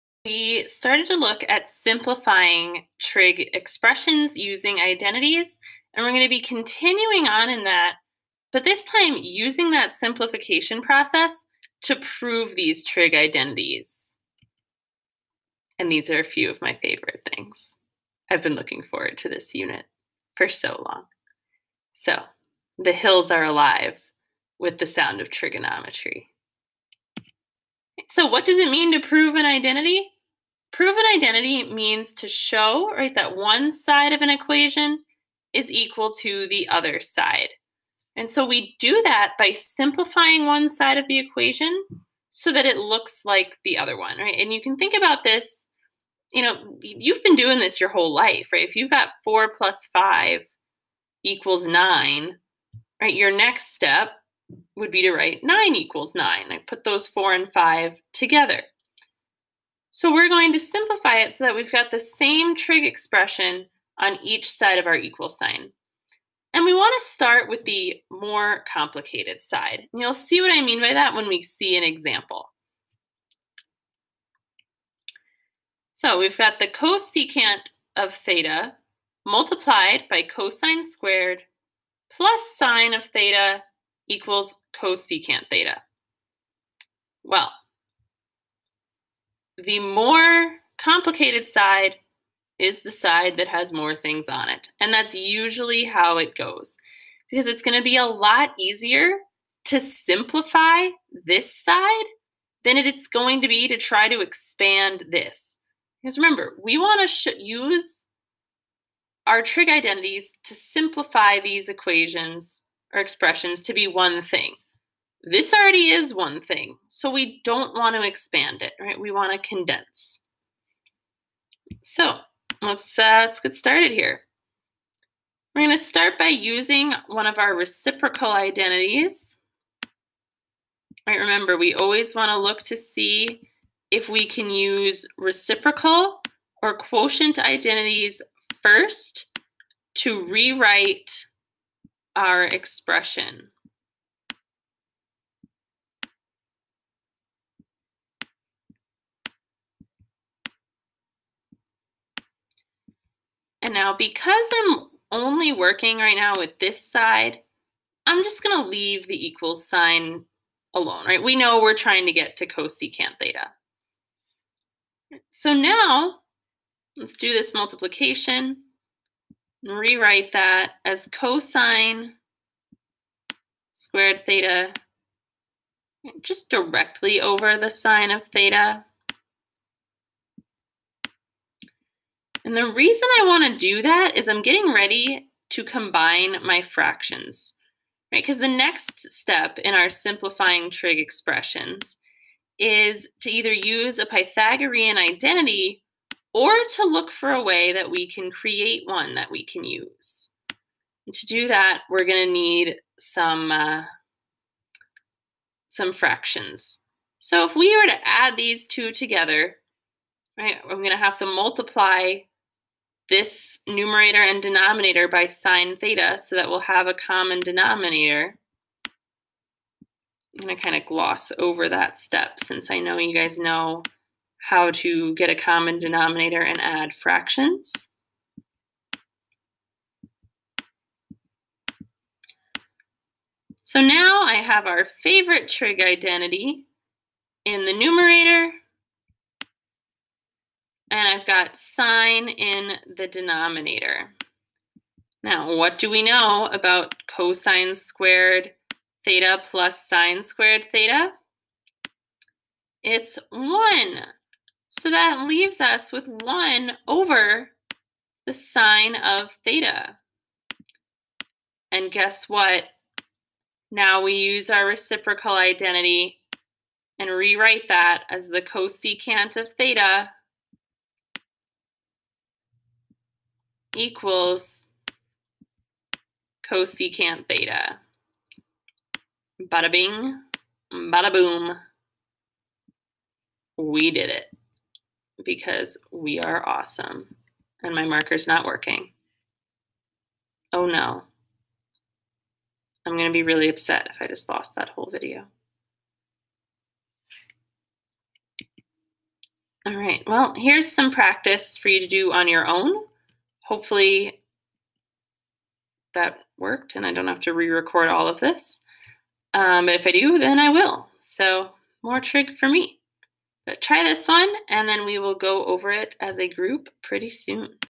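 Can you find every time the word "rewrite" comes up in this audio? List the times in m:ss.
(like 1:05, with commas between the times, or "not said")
2:20, 2:49, 4:27.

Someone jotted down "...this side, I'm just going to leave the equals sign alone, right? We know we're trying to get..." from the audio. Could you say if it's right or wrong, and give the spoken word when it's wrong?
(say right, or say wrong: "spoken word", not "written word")
right.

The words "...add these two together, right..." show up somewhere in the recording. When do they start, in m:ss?
3:28.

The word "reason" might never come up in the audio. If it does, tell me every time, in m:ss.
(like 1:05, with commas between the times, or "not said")
3:02.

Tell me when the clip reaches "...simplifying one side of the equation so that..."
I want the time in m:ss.
0:39.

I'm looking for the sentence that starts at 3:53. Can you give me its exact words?
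So now I have our favorite trig identity in the numerator and I've got sine in the denominator.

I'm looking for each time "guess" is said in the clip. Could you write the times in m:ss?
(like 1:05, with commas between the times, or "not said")
4:21.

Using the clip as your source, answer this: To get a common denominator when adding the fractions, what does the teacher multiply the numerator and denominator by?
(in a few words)
sine theta.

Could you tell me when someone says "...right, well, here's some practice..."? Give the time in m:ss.
4:59.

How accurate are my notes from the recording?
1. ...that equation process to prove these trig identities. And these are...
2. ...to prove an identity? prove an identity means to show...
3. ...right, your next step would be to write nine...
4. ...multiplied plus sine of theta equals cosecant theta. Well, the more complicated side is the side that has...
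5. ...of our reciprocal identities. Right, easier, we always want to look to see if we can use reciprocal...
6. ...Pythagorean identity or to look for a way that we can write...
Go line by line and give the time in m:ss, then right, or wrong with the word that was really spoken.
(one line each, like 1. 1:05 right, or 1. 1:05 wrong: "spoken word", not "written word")
1. 0:09 wrong: "simplification", not "equation"
2. 0:28 right
3. 0:52 right
4. 1:20 wrong: "squared", not "multiplied"
5. 2:07 wrong: "remember", not "easier"
6. 3:14 wrong: "create", not "write".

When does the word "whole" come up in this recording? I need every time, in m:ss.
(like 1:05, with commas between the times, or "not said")
0:47, 4:54.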